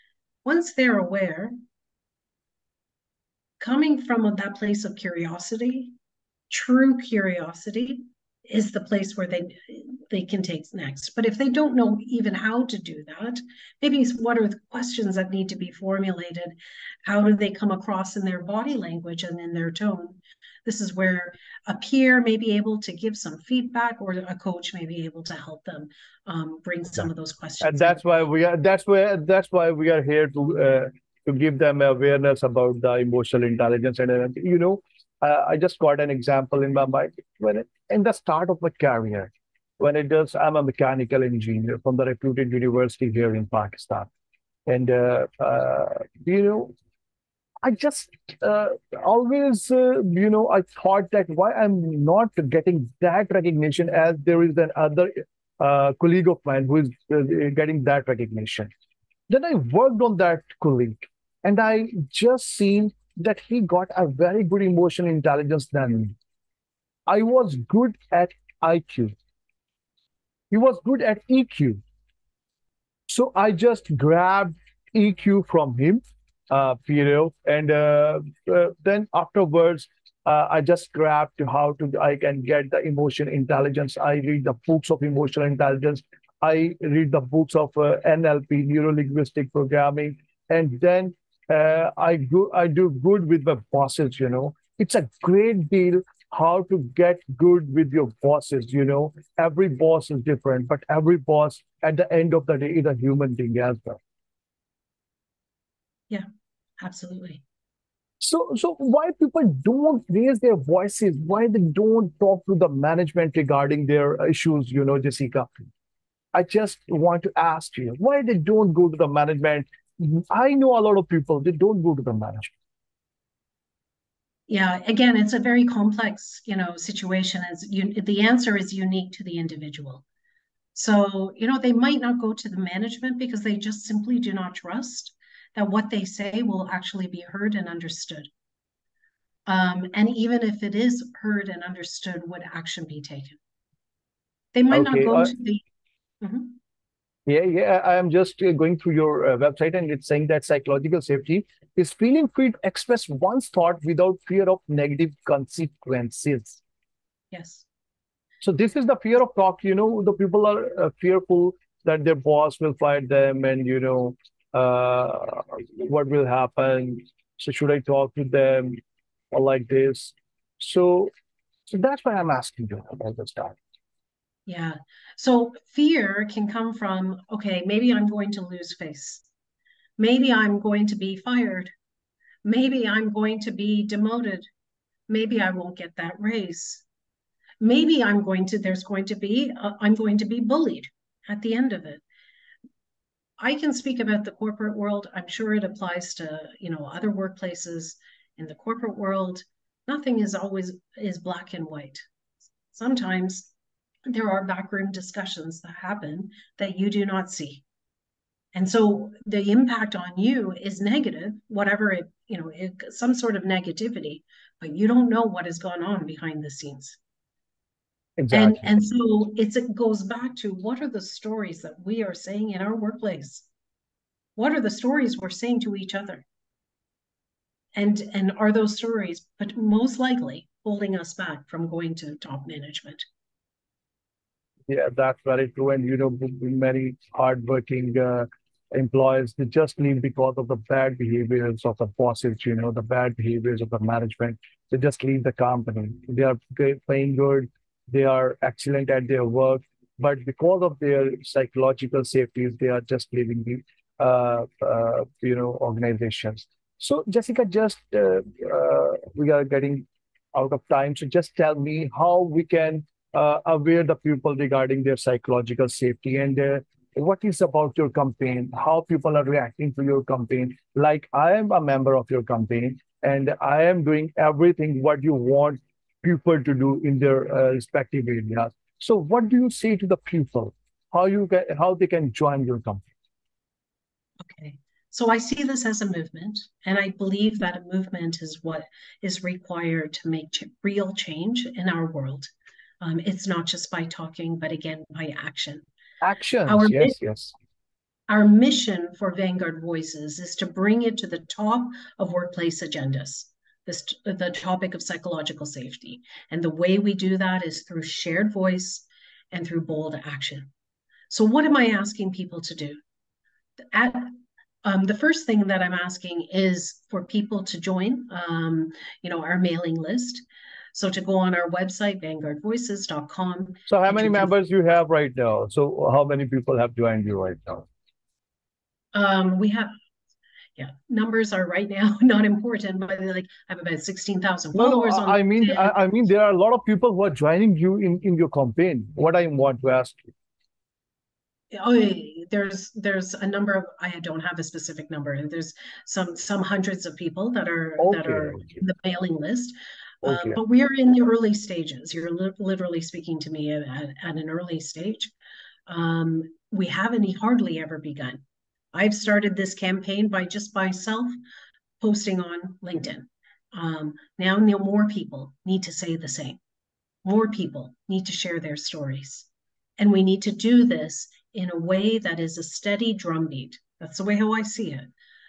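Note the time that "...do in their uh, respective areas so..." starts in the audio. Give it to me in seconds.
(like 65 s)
276 s.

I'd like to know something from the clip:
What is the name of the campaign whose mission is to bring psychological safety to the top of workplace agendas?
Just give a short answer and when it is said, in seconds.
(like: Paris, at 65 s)
Vanguard Voices, at 299 s.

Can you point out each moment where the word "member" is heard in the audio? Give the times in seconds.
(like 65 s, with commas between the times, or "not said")
271 s, 324 s.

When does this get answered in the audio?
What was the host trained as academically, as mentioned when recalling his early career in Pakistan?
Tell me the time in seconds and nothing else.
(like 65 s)
40 s.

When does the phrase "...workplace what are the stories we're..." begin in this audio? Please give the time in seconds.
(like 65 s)
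222 s.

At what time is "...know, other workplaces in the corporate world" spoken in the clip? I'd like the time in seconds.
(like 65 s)
196 s.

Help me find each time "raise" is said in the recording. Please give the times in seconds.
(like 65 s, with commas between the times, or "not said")
110 s, 186 s.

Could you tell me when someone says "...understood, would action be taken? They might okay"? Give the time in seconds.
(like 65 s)
141 s.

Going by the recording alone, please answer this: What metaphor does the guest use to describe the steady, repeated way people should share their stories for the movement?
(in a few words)
A steady drumbeat.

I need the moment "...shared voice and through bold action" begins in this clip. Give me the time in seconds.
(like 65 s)
307 s.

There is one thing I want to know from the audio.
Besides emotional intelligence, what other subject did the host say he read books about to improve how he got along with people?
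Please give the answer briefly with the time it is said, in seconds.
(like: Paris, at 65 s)
Neuro linguistic programming, at 88 s.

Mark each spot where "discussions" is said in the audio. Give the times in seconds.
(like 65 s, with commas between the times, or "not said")
204 s.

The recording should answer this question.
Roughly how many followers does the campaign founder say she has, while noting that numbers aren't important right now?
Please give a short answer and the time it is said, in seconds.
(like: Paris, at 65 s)
16,000, at 333 s.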